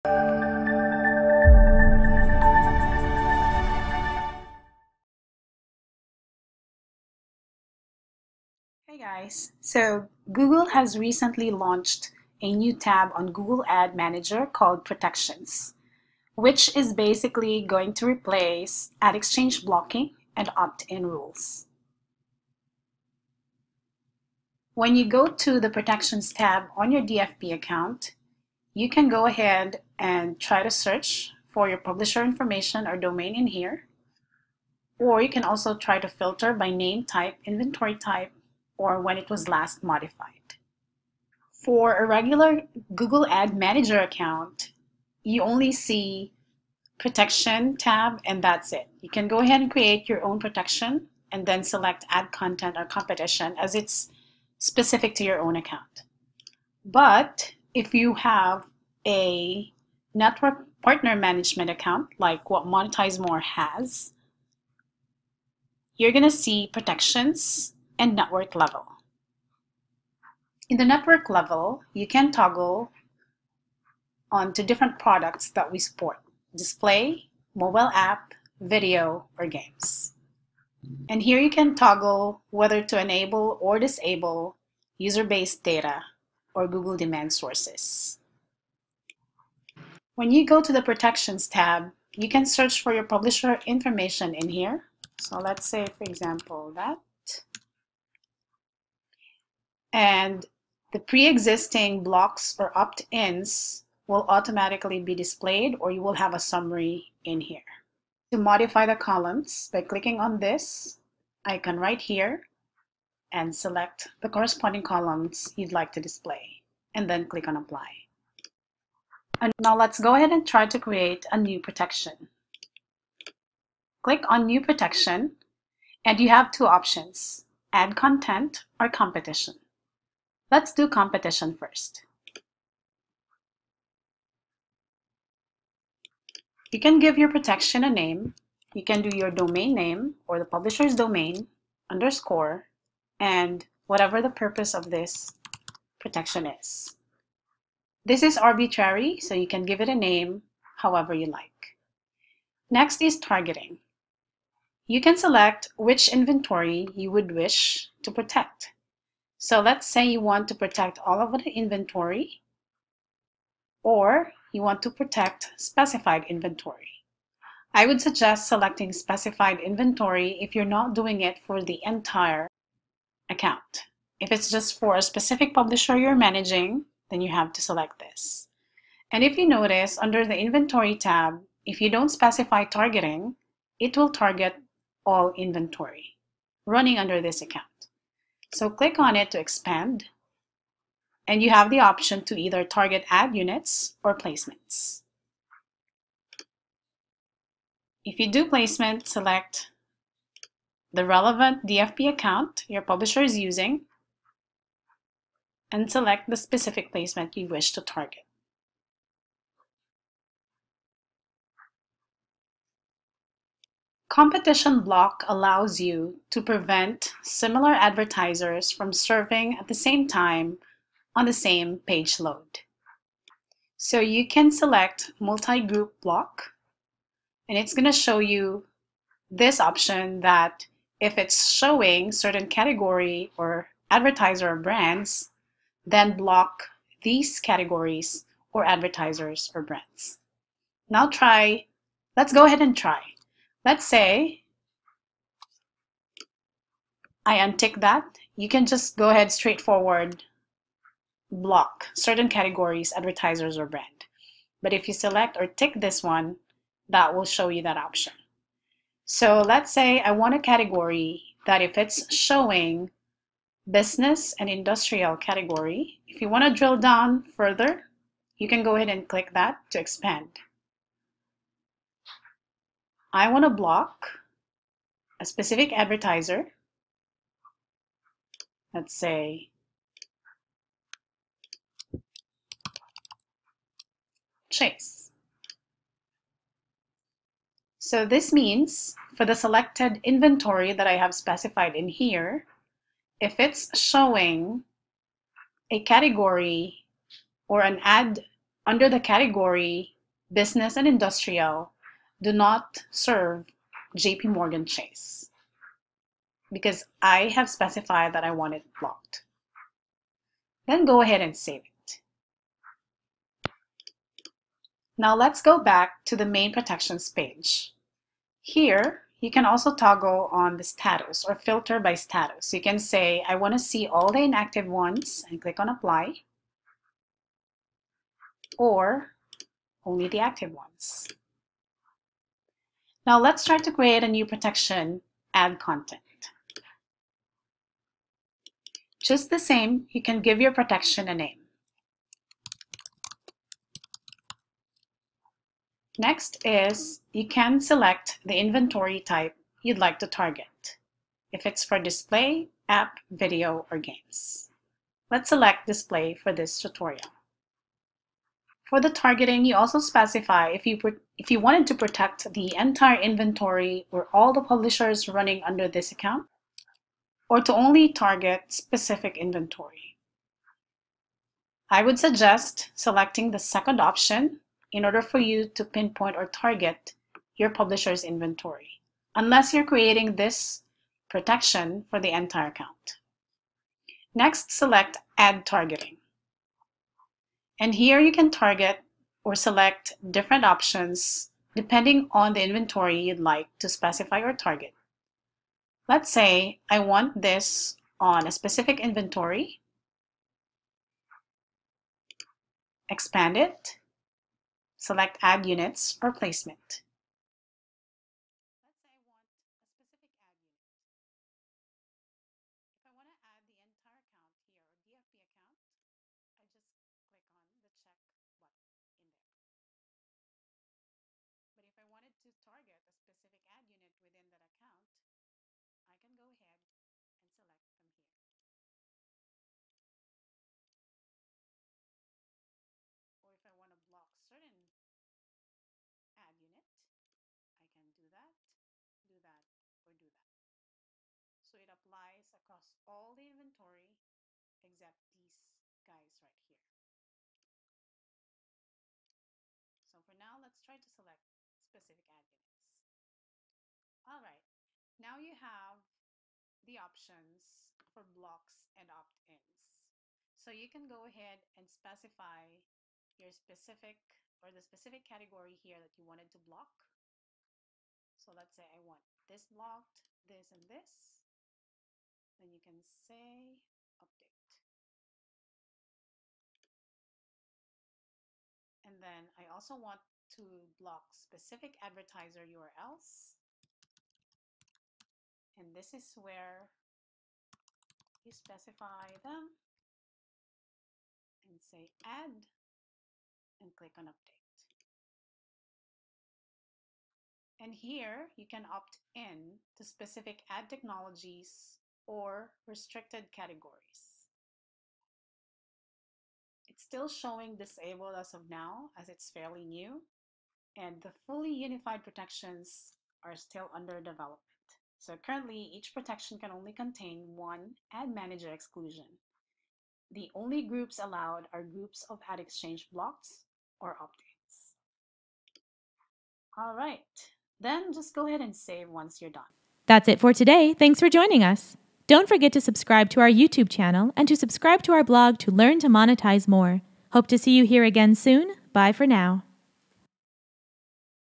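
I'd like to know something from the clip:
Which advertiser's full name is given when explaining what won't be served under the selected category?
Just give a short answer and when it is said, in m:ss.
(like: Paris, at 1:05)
JP Morgan Chase, at 5:03.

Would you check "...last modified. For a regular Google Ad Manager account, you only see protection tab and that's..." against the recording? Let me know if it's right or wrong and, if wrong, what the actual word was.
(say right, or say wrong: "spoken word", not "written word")
right.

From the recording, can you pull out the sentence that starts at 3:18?
If you do placement, select the relevant DFP account your publisher is using and select the specific placement you wish to target.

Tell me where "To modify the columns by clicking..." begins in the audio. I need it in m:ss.
1:48.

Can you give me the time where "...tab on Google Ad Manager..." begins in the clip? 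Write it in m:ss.
0:12.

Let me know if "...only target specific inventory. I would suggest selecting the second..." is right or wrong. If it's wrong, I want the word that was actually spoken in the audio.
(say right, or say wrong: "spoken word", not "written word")
right.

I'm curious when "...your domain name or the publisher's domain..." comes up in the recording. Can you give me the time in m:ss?
2:19.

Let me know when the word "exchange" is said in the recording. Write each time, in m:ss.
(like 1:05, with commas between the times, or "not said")
0:19, 8:42.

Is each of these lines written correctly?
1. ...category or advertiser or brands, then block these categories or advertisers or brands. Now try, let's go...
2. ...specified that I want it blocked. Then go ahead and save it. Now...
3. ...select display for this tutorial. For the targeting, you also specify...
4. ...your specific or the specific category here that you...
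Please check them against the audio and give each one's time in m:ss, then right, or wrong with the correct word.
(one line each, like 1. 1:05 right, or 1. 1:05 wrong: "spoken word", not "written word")
1. 3:52 right
2. 5:07 right
3. 5:55 right
4. 7:43 right.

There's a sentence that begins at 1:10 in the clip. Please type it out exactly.
In the network level, you can toggle onto different products that we support, display, mobile app, video, or games.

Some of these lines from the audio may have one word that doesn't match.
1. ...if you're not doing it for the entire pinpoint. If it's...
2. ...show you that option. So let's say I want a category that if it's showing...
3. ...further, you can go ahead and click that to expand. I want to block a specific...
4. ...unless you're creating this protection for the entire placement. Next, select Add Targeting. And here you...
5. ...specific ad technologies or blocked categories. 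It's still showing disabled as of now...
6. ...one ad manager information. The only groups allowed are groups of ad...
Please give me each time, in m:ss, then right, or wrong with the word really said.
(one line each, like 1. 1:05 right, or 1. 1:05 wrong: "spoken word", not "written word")
1. 2:50 wrong: "account", not "pinpoint"
2. 4:17 right
3. 4:27 right
4. 6:19 wrong: "account", not "placement"
5. 8:19 wrong: "restricted", not "blocked"
6. 8:37 wrong: "exclusion", not "information".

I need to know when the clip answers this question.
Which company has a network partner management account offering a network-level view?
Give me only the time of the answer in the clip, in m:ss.
1:02.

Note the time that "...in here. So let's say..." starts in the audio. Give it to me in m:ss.
1:34.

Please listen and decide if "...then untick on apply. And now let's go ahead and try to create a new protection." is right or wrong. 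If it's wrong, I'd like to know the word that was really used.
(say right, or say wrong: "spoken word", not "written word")
wrong: "click", not "untick".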